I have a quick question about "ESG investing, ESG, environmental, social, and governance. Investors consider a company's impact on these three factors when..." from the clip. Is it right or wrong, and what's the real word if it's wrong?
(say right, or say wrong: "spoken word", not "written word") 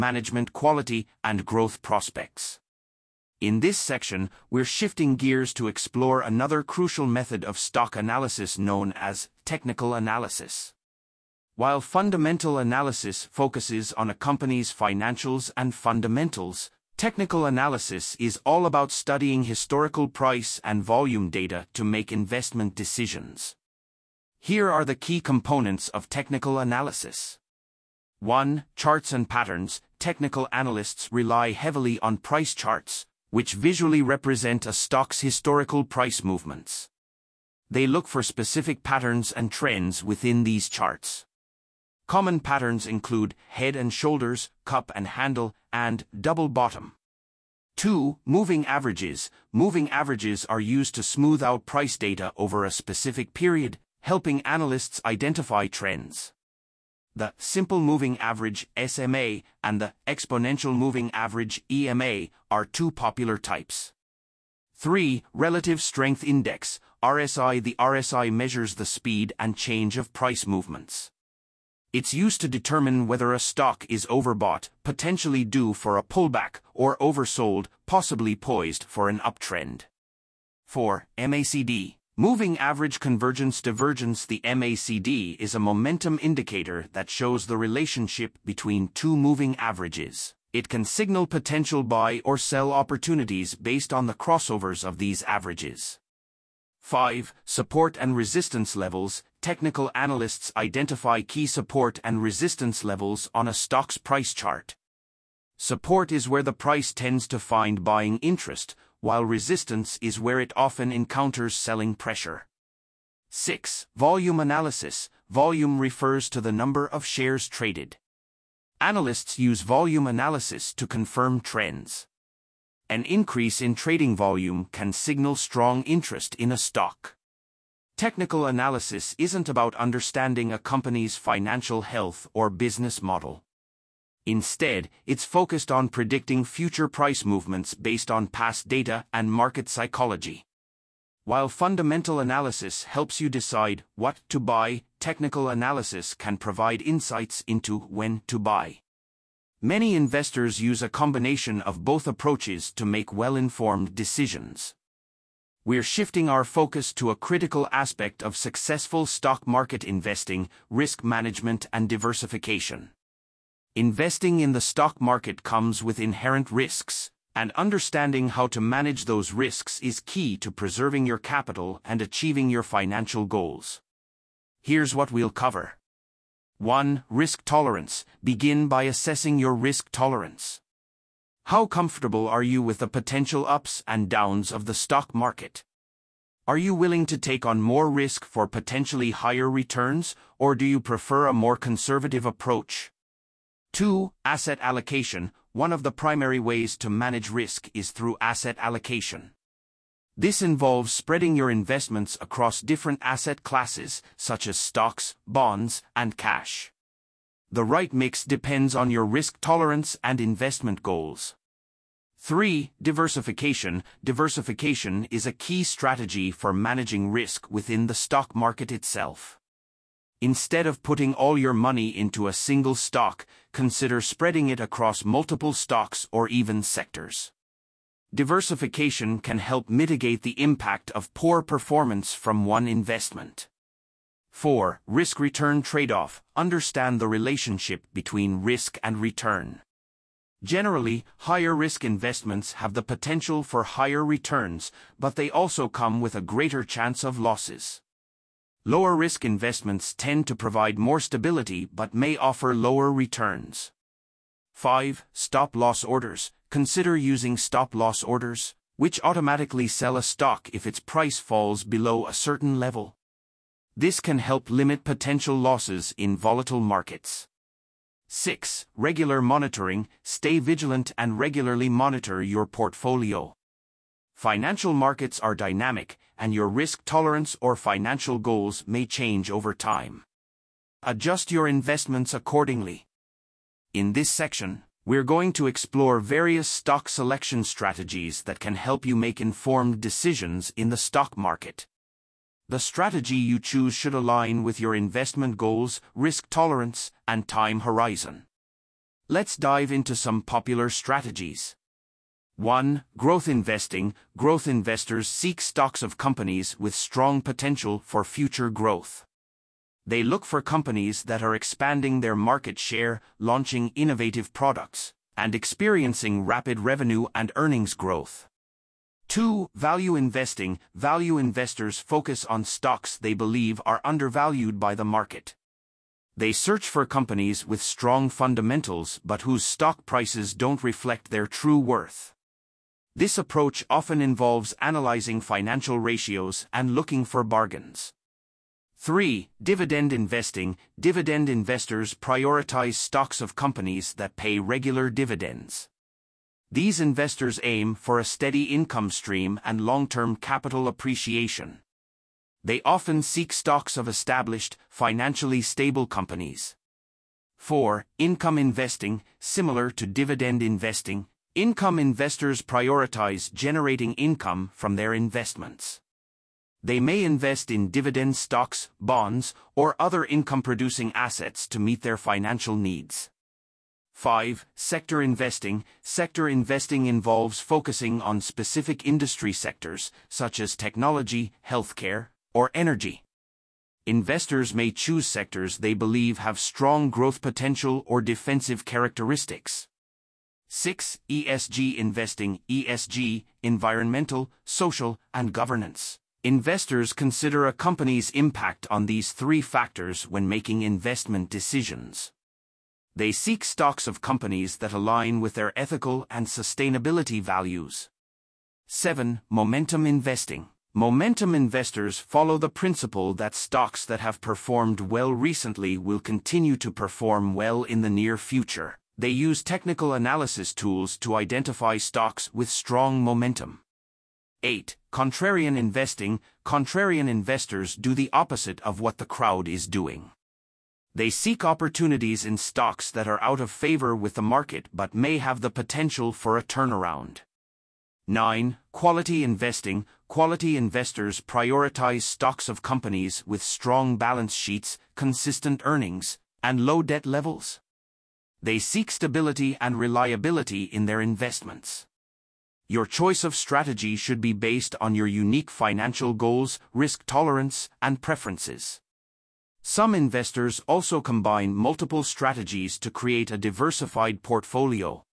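right.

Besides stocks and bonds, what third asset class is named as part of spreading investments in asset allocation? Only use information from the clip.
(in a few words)
Cash.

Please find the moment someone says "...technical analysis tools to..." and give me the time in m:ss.
6:59.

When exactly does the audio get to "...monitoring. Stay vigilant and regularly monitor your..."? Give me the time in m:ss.
4:29.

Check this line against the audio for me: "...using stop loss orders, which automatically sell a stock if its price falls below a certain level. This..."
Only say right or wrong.
right.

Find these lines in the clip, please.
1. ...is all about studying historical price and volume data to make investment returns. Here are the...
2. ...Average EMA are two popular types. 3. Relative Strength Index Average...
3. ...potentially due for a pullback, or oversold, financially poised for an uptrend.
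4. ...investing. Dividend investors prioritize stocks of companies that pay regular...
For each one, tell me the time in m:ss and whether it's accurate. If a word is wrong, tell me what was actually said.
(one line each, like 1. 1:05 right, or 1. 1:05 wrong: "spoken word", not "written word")
1. 0:18 wrong: "decisions", not "returns"
2. 1:01 wrong: "RSI", not "Average"
3. 1:14 wrong: "possibly", not "financially"
4. 5:39 right.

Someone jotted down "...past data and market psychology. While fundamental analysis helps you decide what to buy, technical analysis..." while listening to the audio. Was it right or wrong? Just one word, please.
right.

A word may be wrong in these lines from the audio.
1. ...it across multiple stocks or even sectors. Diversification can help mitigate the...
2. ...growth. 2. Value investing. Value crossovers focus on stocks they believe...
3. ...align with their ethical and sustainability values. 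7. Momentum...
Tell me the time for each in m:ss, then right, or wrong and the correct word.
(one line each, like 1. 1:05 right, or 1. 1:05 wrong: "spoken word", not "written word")
1. 3:44 right
2. 5:17 wrong: "investors", not "crossovers"
3. 6:44 right.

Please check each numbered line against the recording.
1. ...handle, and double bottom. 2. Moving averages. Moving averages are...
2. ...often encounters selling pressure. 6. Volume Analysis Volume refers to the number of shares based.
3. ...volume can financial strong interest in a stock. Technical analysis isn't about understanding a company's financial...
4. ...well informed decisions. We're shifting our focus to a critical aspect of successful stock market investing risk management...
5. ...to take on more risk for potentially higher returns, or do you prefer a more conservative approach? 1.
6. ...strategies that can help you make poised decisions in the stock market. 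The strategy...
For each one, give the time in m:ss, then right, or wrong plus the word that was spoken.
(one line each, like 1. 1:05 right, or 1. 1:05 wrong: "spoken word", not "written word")
1. 0:45 right
2. 1:50 wrong: "traded", not "based"
3. 2:04 wrong: "signal", not "financial"
4. 2:33 right
5. 3:07 wrong: "2", not "1"
6. 4:47 wrong: "informed", not "poised".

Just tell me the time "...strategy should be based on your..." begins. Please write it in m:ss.
7:33.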